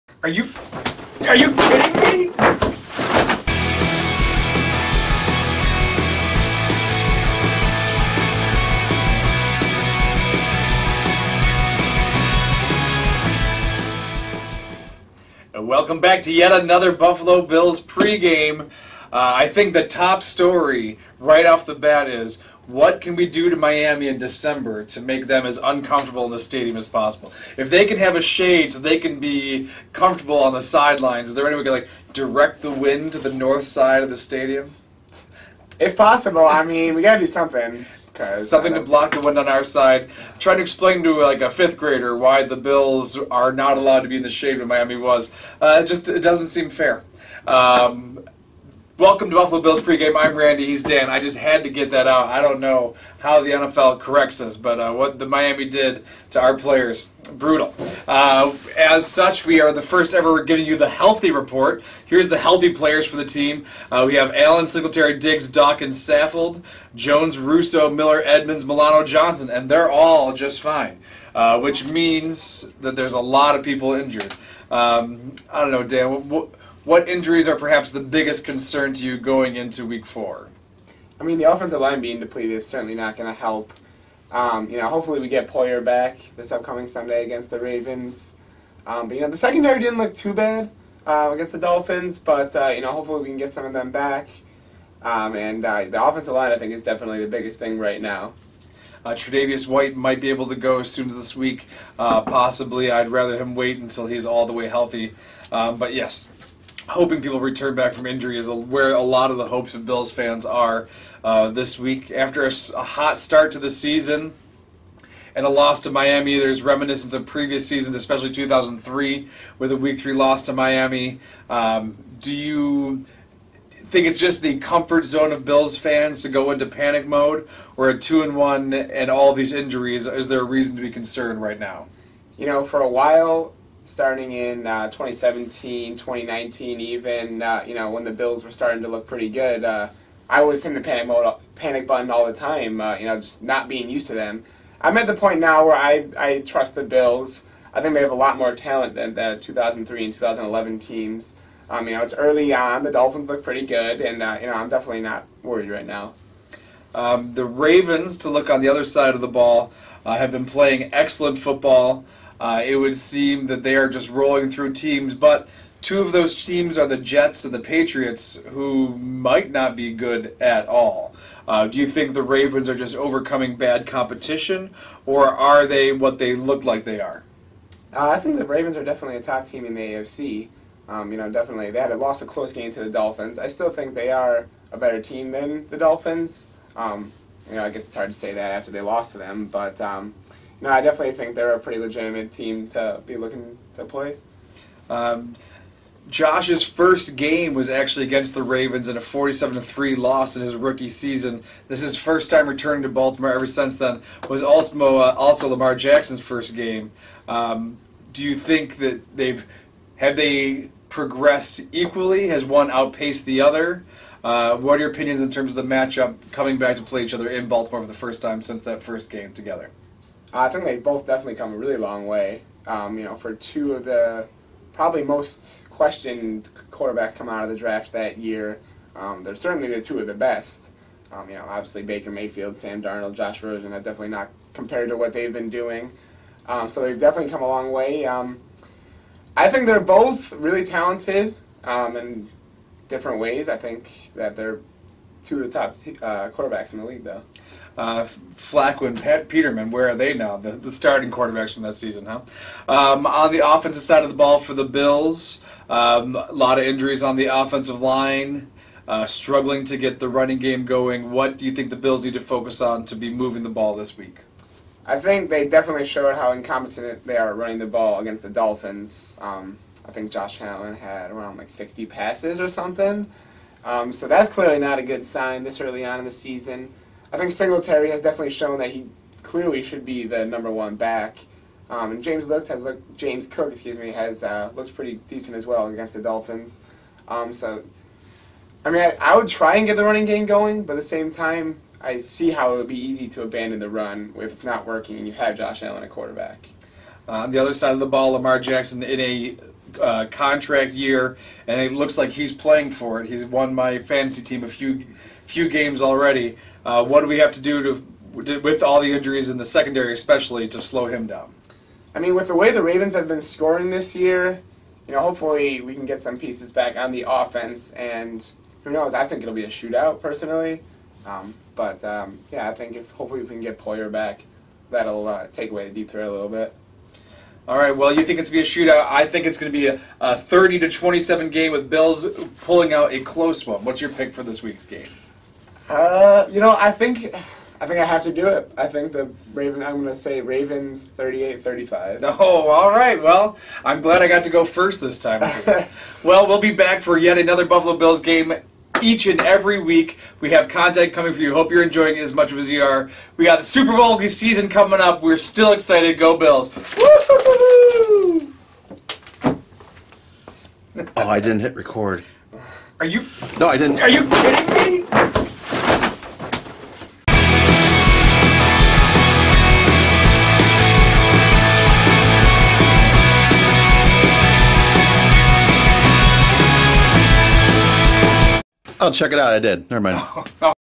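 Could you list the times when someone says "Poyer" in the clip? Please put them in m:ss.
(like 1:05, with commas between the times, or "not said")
1:25, 5:23.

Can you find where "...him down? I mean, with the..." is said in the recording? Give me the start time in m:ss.
5:10.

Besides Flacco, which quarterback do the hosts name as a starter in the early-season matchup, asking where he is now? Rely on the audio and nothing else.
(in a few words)
Pat Peterman.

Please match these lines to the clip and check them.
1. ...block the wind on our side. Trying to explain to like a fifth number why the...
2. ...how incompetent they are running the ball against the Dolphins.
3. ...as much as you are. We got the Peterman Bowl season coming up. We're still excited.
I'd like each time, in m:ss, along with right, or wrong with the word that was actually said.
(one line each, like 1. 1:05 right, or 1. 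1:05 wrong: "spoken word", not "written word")
1. 0:38 wrong: "grader", not "number"
2. 4:26 right
3. 5:52 wrong: "Super", not "Peterman".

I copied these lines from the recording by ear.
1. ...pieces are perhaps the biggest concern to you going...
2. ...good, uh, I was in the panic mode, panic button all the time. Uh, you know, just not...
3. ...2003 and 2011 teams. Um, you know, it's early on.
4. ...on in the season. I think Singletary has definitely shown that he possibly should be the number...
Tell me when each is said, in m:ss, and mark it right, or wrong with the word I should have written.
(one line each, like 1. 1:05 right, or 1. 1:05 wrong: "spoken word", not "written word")
1. 1:17 wrong: "injuries", not "pieces"
2. 2:19 right
3. 2:29 right
4. 4:35 wrong: "clearly", not "possibly".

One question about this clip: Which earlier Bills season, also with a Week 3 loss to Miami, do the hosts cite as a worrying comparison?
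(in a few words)
2003.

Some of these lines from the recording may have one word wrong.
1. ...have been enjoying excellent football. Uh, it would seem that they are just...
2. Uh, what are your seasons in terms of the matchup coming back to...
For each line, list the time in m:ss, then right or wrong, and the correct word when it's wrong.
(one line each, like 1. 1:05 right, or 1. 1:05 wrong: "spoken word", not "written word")
1. 2:40 wrong: "playing", not "enjoying"
2. 3:34 wrong: "opinions", not "seasons".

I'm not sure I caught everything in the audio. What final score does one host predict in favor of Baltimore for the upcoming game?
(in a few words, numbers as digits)
38-35.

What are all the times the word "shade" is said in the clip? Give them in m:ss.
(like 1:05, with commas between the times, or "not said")
0:28, 0:44.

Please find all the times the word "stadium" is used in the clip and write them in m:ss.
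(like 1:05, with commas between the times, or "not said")
0:26, 0:34.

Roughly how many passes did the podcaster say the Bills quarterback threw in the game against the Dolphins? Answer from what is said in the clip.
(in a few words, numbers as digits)
60.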